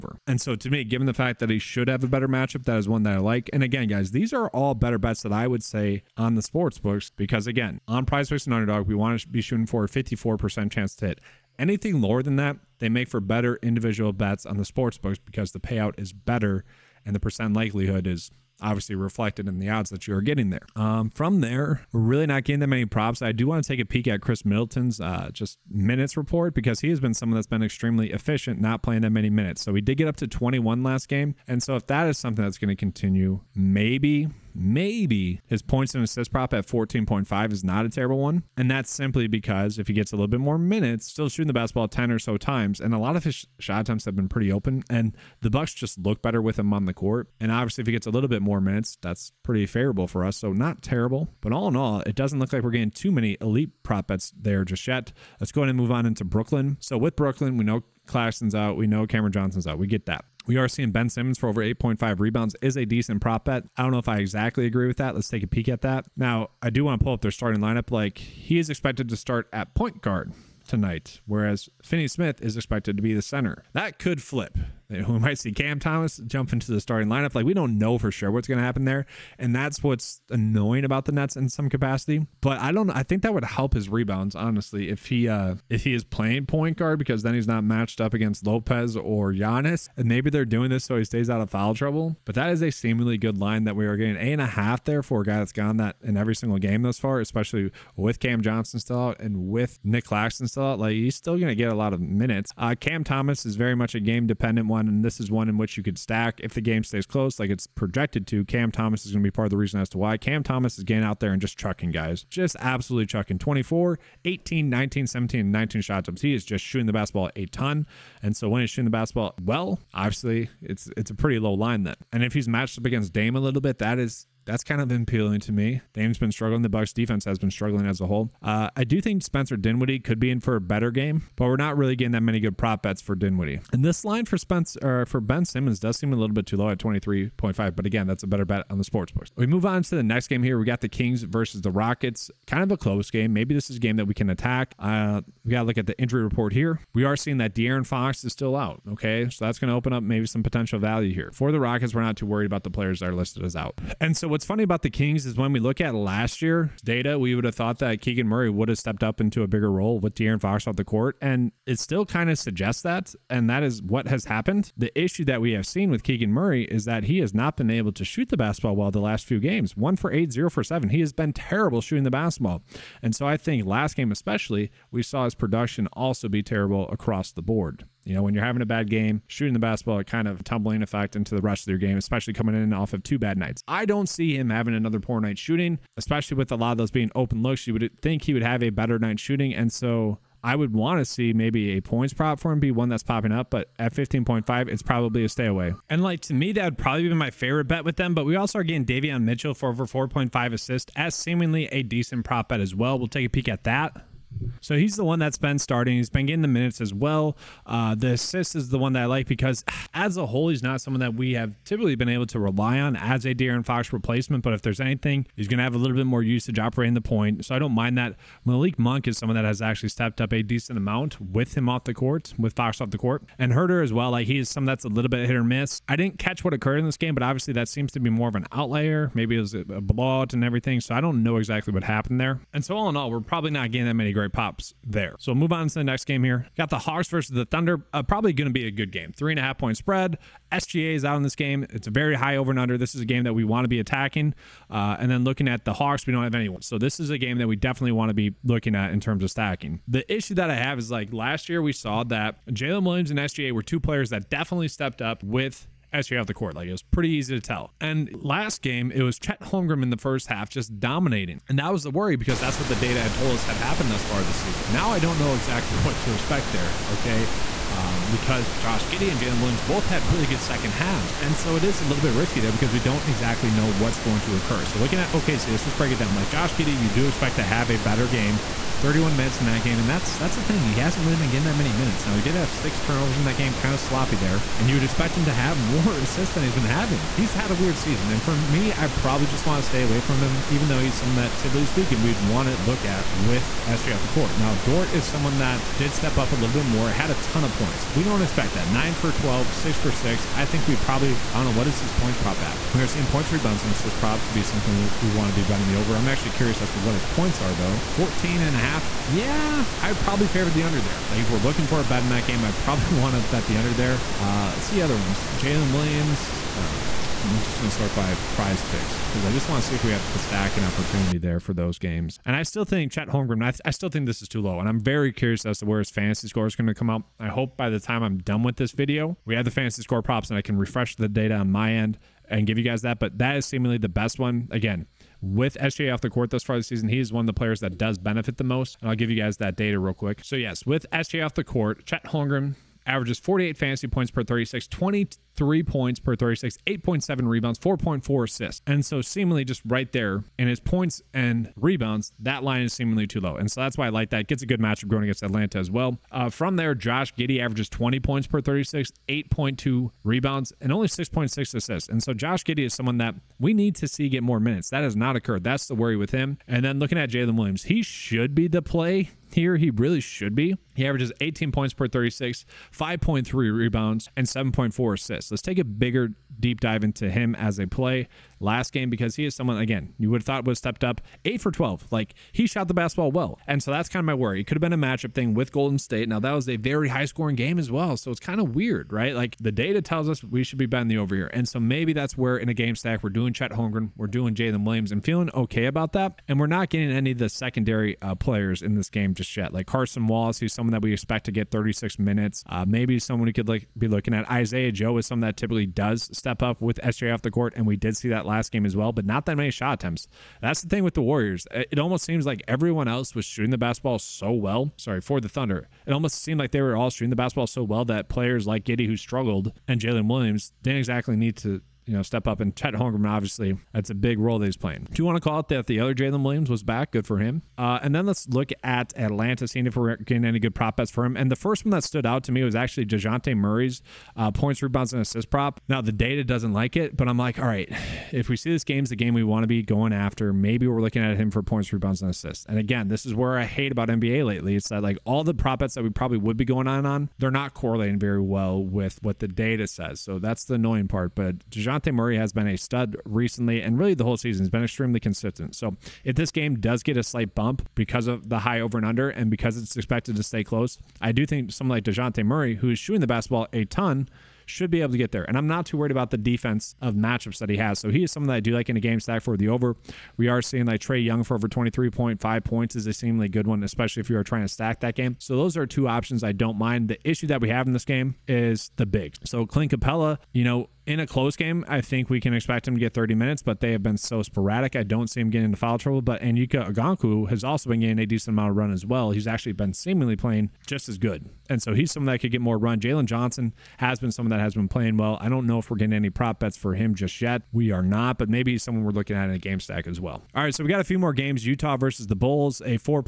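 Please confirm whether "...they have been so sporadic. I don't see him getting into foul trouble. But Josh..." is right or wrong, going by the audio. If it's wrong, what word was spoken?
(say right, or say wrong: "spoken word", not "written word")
wrong: "Onyeka", not "Josh".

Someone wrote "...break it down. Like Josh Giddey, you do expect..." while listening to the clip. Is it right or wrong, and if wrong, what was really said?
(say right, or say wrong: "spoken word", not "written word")
right.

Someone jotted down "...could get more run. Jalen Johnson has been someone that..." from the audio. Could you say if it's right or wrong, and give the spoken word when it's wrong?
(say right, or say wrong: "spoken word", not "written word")
right.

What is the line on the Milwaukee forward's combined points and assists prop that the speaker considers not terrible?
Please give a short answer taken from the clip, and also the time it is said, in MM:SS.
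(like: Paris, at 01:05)
14.5, at 00:36.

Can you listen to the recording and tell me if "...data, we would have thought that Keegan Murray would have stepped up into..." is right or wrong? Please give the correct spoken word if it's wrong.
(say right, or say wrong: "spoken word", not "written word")
right.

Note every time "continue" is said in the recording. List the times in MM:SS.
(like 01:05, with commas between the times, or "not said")
00:32.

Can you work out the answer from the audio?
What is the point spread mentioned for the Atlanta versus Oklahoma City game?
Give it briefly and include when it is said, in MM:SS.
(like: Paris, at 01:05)
3.5, at 03:59.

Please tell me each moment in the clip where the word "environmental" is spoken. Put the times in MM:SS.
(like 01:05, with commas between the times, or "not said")
not said.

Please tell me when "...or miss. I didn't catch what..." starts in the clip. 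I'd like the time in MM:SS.
03:45.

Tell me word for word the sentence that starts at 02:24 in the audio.
Uh, we got to look at the injury report here.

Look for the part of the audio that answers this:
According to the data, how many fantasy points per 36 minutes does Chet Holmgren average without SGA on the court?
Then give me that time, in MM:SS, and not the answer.
05:43.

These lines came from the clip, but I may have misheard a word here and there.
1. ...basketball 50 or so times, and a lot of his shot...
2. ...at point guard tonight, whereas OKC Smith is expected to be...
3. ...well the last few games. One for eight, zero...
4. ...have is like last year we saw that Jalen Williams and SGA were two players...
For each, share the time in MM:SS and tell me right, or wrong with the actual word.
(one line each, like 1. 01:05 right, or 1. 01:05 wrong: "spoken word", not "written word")
1. 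00:41 wrong: "10", not "50"
2. 01:09 wrong: "Finney", not "OKC"
3. 02:48 right
4. 04:10 right.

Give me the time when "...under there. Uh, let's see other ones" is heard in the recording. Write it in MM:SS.
05:13.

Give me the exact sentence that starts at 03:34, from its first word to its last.
But if there's anything, he's going to have a little bit more usage operating the point.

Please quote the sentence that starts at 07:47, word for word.
So he is someone that I do like in a game stack for the over.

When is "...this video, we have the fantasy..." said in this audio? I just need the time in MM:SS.
05:28.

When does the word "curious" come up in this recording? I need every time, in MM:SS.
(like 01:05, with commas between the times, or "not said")
05:06, 05:25.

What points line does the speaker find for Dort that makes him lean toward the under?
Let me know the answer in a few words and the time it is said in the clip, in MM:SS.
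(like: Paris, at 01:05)
14.5, at 05:07.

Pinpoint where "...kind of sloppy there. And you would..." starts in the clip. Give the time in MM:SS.
04:43.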